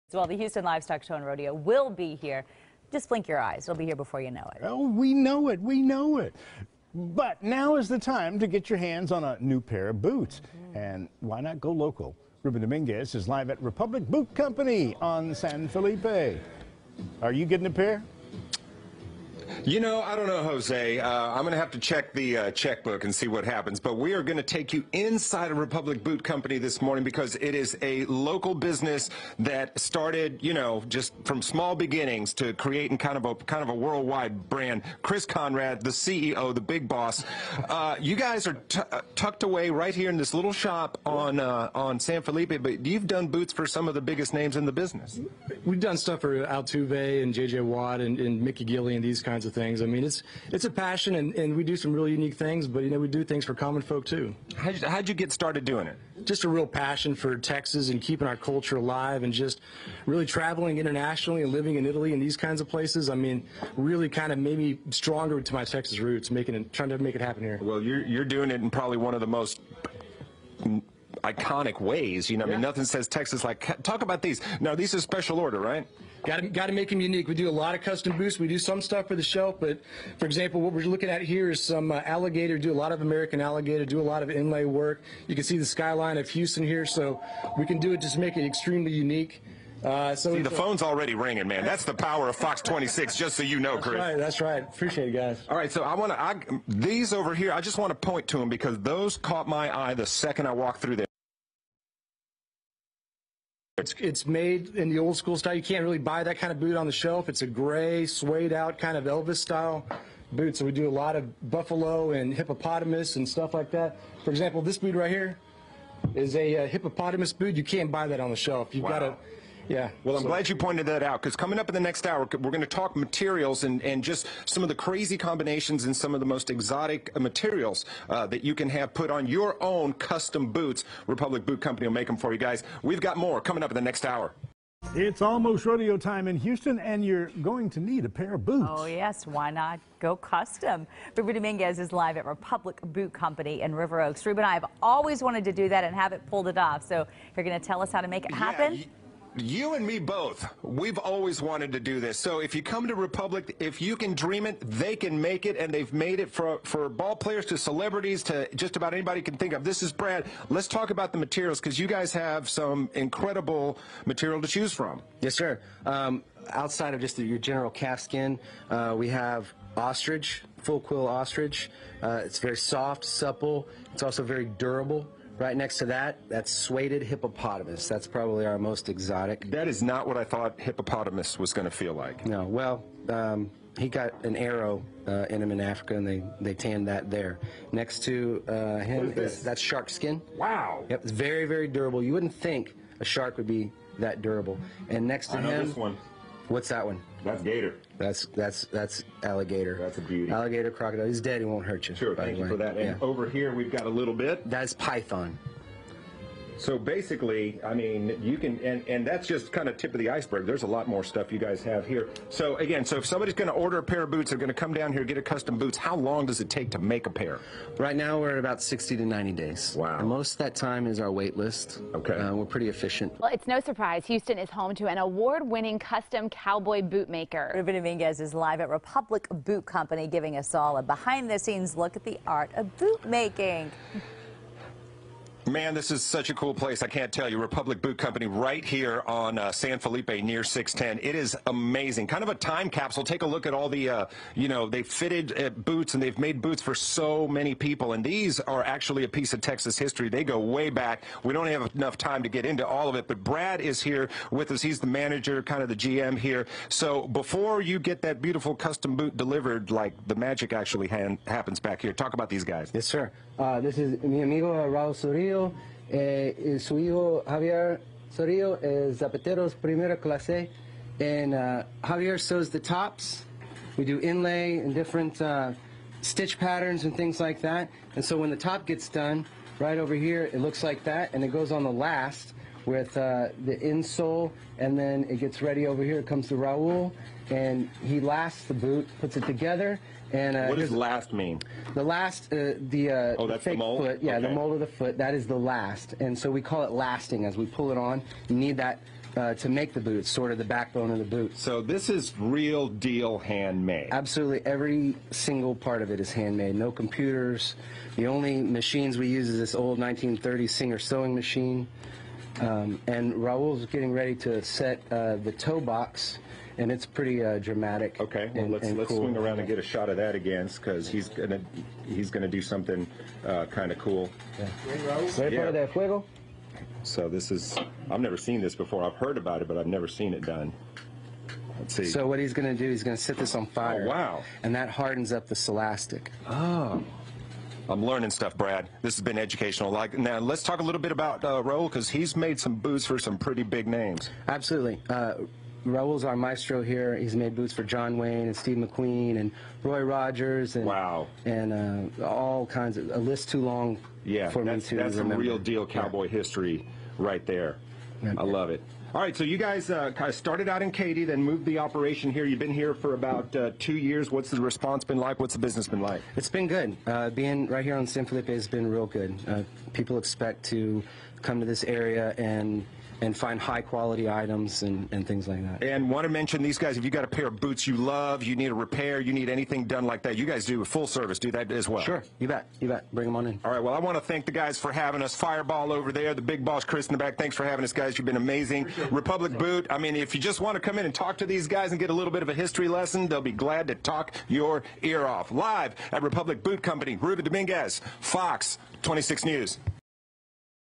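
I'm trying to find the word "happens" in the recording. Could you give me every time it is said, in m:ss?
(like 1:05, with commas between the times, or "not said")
0:23, 1:07, 2:28, 4:20.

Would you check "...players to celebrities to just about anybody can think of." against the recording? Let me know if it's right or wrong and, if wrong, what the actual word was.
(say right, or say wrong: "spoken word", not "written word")
right.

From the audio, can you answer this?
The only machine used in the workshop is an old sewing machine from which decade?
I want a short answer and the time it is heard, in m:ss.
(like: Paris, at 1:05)
1930s, at 5:09.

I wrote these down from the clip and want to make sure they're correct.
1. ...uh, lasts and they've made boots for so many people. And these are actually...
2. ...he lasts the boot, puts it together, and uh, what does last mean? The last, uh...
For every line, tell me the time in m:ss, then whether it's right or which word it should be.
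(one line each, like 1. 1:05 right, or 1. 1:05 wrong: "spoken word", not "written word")
1. 4:05 wrong: "boots", not "lasts"
2. 4:47 right.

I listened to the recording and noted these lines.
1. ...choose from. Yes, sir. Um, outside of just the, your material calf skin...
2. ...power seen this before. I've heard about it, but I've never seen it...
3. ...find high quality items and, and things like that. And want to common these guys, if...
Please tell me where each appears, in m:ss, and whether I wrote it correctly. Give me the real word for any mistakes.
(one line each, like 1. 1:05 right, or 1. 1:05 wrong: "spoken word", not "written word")
1. 2:44 wrong: "general", not "material"
2. 5:28 wrong: "never", not "power"
3. 6:13 wrong: "mention", not "common".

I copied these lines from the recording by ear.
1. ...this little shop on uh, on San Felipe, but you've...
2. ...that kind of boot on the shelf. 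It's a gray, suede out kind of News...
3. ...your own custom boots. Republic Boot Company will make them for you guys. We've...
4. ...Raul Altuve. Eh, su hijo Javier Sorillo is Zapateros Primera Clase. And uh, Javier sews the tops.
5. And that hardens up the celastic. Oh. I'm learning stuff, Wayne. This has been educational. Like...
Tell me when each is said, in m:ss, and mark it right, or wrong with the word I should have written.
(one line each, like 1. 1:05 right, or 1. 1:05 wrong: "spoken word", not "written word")
1. 0:40 right
2. 1:46 wrong: "Elvis", not "News"
3. 2:09 right
4. 4:24 wrong: "Sorillo", not "Altuve"
5. 5:34 wrong: "Brad", not "Wayne".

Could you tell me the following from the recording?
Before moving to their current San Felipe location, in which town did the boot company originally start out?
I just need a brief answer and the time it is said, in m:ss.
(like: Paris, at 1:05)
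Katy, at 6:00.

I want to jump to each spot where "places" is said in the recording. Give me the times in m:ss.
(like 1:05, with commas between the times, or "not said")
1:02, 3:56.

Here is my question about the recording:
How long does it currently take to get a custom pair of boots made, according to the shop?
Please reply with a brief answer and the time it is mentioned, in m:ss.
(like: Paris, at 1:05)
60 to 90 days, at 3:38.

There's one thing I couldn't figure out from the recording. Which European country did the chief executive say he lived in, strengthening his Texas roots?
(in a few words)
Italy.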